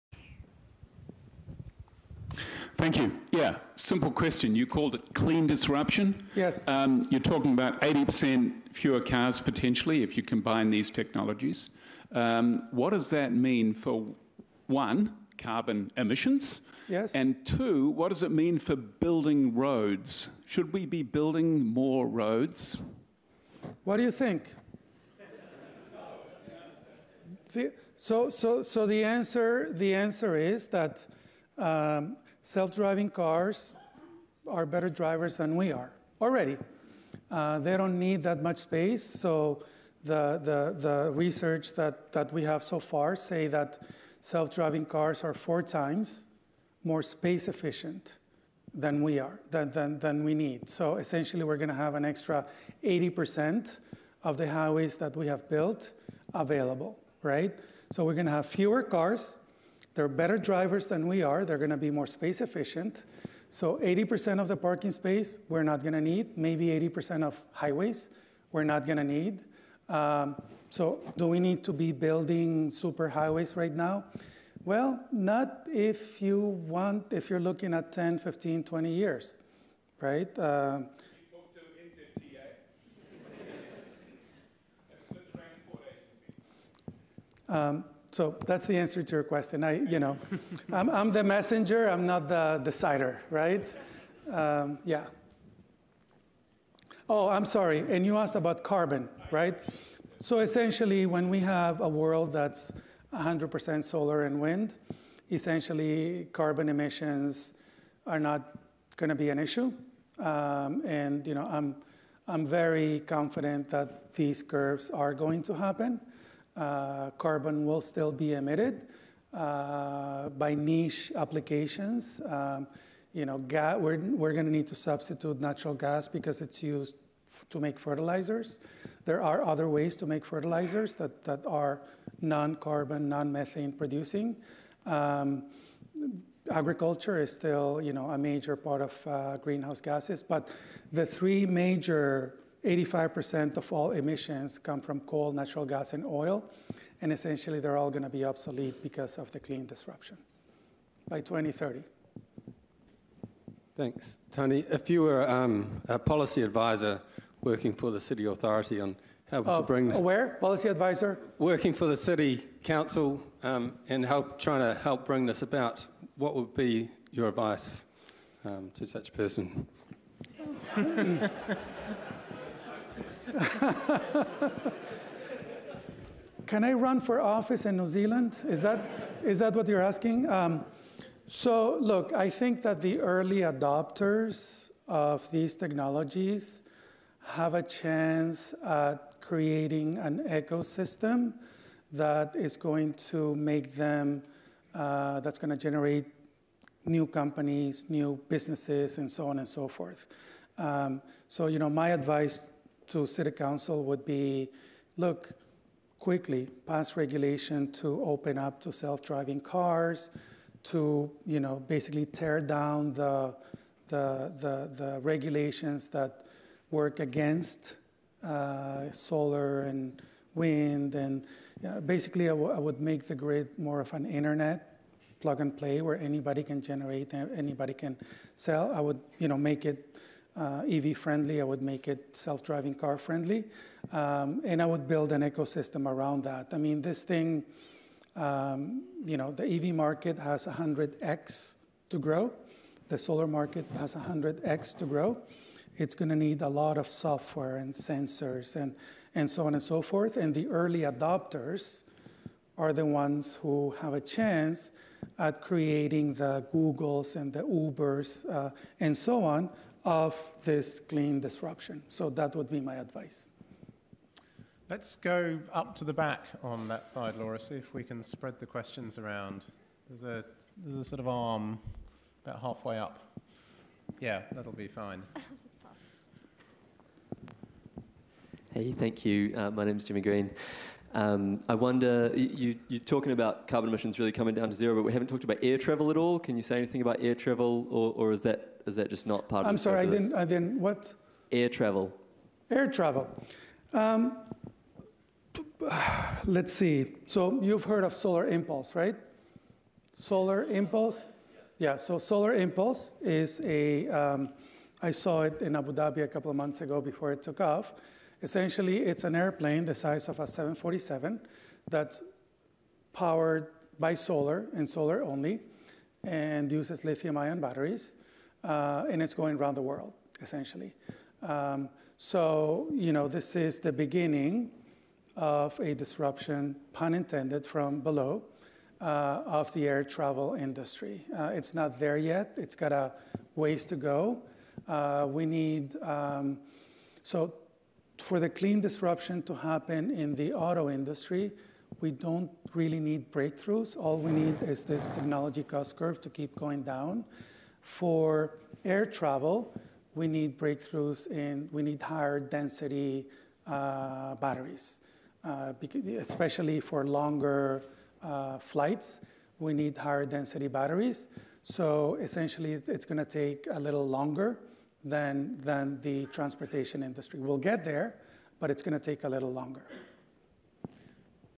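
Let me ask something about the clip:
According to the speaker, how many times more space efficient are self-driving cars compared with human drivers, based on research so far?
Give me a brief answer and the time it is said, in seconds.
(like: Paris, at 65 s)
4 times, at 45 s.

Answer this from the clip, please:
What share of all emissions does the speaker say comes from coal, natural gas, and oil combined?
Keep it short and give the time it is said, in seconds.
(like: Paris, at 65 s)
85%, at 142 s.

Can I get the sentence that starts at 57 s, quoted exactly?
So we're gonna have fewer cars, they're better drivers than we are.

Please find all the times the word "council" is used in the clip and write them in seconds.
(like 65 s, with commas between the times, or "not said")
162 s, 203 s.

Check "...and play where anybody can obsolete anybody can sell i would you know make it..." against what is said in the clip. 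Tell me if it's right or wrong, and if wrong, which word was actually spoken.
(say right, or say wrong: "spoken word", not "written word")
wrong: "generate", not "obsolete".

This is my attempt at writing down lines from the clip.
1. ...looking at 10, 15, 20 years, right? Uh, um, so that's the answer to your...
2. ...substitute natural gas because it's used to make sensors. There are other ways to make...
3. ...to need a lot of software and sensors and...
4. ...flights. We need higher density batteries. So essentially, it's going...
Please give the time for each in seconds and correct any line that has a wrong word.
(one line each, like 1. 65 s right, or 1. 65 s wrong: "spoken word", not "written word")
1. 77 s right
2. 124 s wrong: "fertilizers", not "sensors"
3. 246 s right
4. 358 s right.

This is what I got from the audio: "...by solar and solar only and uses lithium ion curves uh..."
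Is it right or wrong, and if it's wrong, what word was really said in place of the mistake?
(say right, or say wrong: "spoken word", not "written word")
wrong: "batteries", not "curves".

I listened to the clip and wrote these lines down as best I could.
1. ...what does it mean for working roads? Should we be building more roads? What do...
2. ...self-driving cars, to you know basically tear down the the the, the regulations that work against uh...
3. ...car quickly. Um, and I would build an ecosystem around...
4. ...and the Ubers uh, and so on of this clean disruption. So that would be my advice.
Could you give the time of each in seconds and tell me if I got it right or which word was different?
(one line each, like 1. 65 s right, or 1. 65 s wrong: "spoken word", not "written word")
1. 17 s wrong: "building", not "working"
2. 208 s right
3. 232 s wrong: "friendly", not "quickly"
4. 257 s right.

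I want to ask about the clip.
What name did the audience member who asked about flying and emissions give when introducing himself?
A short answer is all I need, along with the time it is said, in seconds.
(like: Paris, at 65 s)
Jimmy Green, at 279 s.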